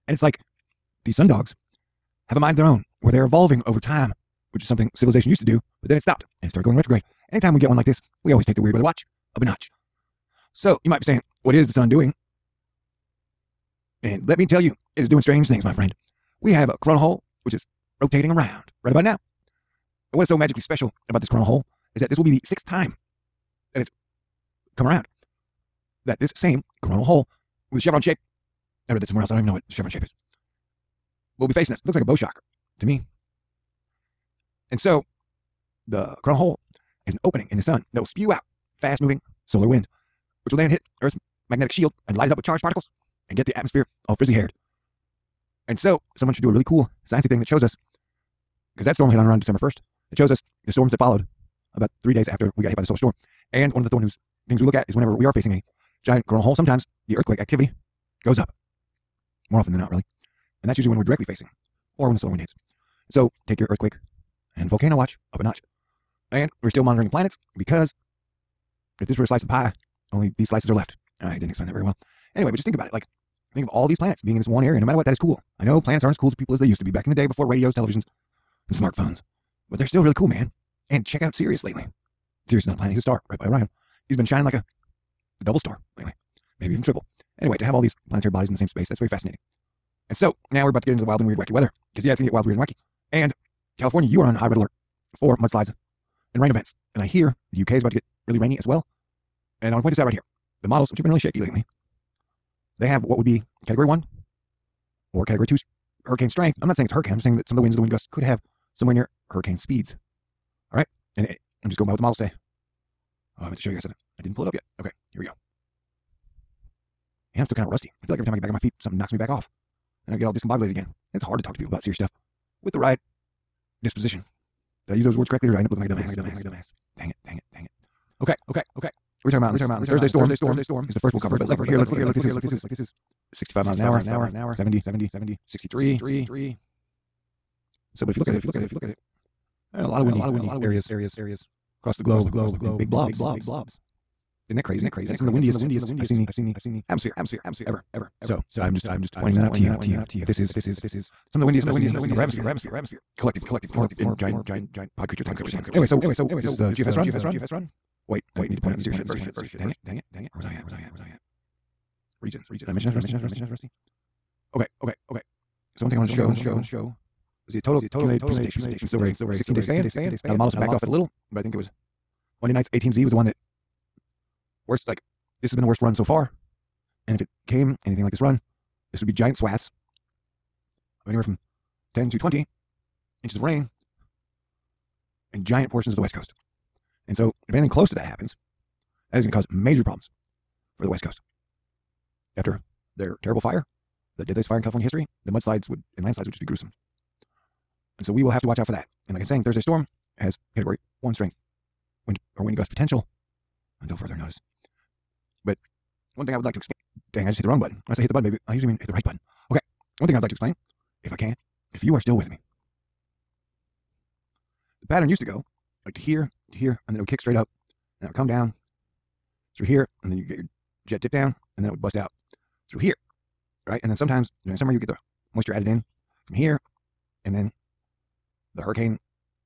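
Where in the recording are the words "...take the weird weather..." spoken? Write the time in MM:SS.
00:08.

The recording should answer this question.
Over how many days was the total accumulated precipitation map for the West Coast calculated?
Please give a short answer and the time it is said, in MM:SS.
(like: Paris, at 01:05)
16, at 02:49.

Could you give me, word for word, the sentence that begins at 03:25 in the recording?
But one thing I would like to explain dang, I just hit the wrong button.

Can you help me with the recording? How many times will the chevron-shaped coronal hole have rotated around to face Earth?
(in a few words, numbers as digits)
6.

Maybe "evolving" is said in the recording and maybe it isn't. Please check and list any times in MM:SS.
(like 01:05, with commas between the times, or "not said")
00:03.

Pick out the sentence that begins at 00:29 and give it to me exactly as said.
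I don't even know what the chevron shape is.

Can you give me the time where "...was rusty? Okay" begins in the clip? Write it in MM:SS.
02:42.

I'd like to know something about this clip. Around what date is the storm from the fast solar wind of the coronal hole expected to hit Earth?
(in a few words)
December 1st.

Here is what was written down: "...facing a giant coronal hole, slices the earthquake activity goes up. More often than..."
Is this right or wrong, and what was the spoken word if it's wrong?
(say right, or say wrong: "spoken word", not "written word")
wrong: "sometimes", not "slices".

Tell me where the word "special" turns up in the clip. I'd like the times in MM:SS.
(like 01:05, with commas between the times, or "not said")
00:20.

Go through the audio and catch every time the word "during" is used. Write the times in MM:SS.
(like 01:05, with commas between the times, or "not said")
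03:44.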